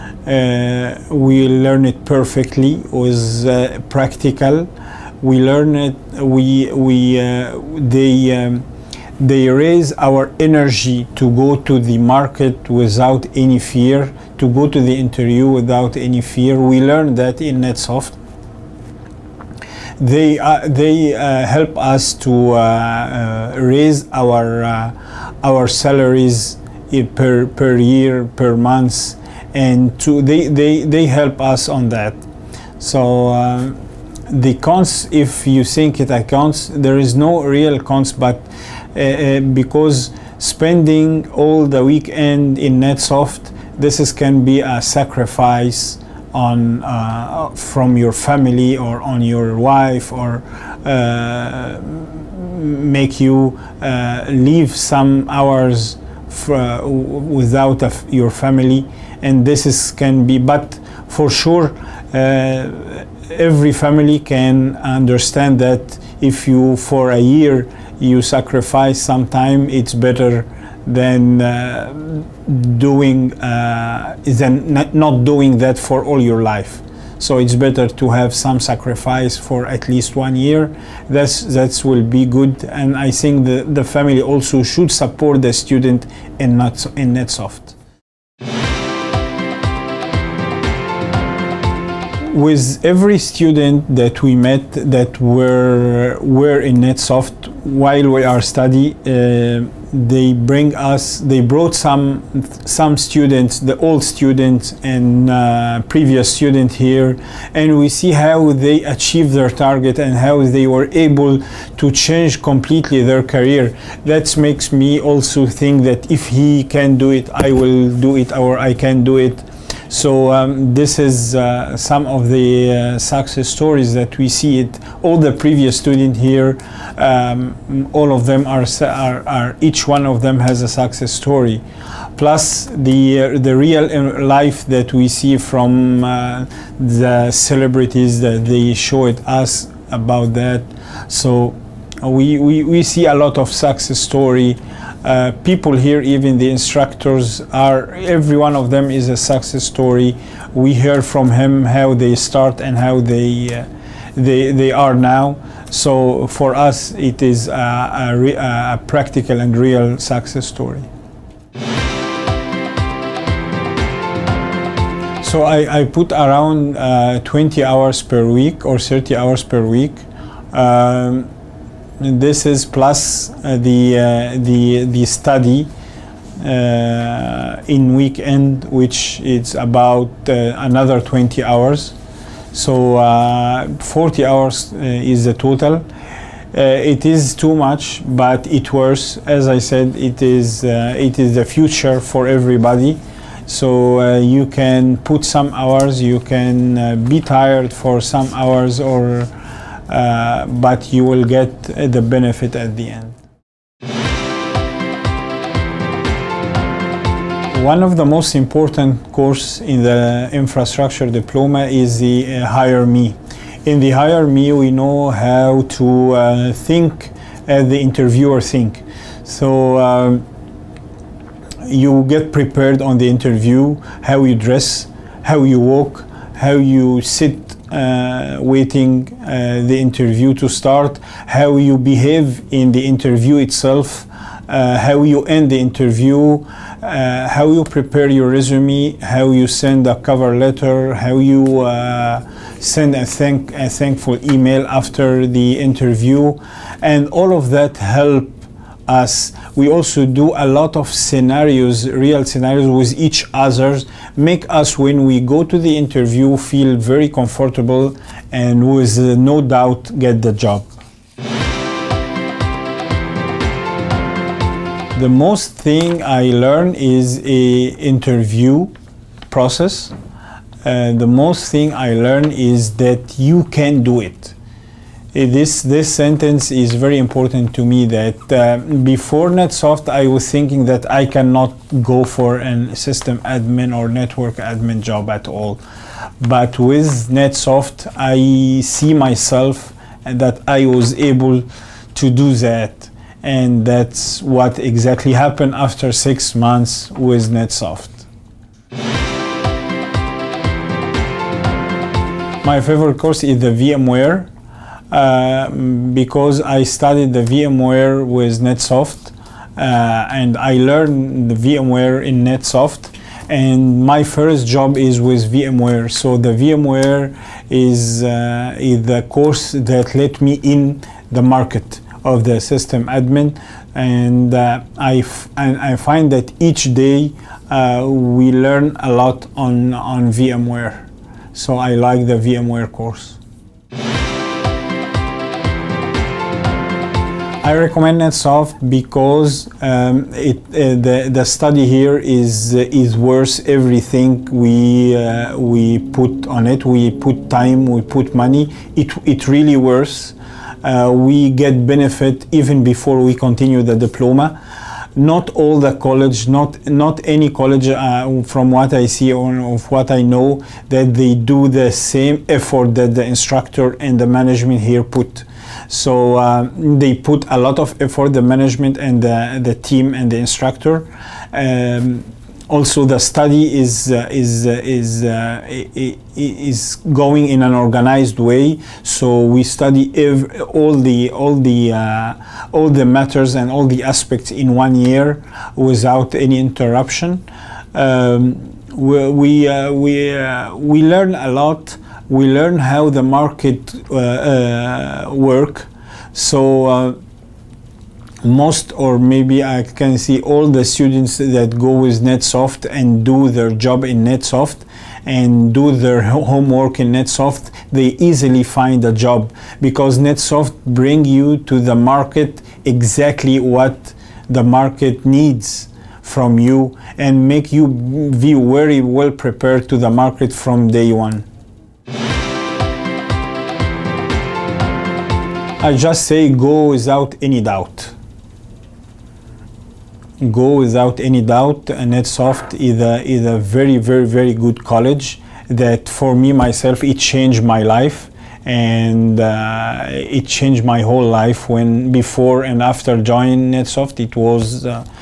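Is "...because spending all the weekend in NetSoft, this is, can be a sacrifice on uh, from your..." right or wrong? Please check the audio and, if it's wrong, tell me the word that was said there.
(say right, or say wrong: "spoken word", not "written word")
right.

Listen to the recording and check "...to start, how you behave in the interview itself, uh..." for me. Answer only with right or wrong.
right.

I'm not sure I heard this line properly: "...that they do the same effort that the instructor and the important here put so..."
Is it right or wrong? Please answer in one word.
wrong.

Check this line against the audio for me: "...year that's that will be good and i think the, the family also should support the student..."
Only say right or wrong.
right.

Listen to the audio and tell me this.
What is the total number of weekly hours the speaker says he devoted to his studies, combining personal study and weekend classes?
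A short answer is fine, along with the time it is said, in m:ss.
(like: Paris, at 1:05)
40 hours, at 3:03.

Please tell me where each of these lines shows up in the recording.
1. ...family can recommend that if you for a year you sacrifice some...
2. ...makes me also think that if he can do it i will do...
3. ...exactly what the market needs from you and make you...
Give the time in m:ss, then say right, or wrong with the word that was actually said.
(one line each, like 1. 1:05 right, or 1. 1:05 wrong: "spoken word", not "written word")
1. 1:03 wrong: "understand", not "recommend"
2. 1:54 right
3. 6:52 right.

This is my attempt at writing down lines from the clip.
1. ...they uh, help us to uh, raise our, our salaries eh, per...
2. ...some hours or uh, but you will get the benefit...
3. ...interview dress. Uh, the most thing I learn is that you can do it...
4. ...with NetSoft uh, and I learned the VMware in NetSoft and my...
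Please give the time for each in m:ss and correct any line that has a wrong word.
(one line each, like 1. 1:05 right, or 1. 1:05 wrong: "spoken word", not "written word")
1. 0:20 right
2. 3:18 right
3. 4:27 wrong: "process", not "dress"
4. 5:08 right.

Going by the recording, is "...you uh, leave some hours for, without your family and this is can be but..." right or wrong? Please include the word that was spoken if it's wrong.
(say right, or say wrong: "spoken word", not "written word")
right.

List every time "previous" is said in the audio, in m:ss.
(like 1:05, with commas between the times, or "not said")
1:45, 2:05.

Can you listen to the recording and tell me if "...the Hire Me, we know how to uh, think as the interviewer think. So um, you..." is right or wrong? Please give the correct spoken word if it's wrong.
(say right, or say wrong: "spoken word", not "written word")
right.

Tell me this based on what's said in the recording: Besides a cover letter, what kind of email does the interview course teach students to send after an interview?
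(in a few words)
thankful email.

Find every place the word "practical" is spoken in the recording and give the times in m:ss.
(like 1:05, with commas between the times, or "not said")
0:03, 2:38.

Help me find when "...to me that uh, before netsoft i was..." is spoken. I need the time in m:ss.
4:37.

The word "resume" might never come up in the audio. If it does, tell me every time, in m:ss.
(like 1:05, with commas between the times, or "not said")
3:58.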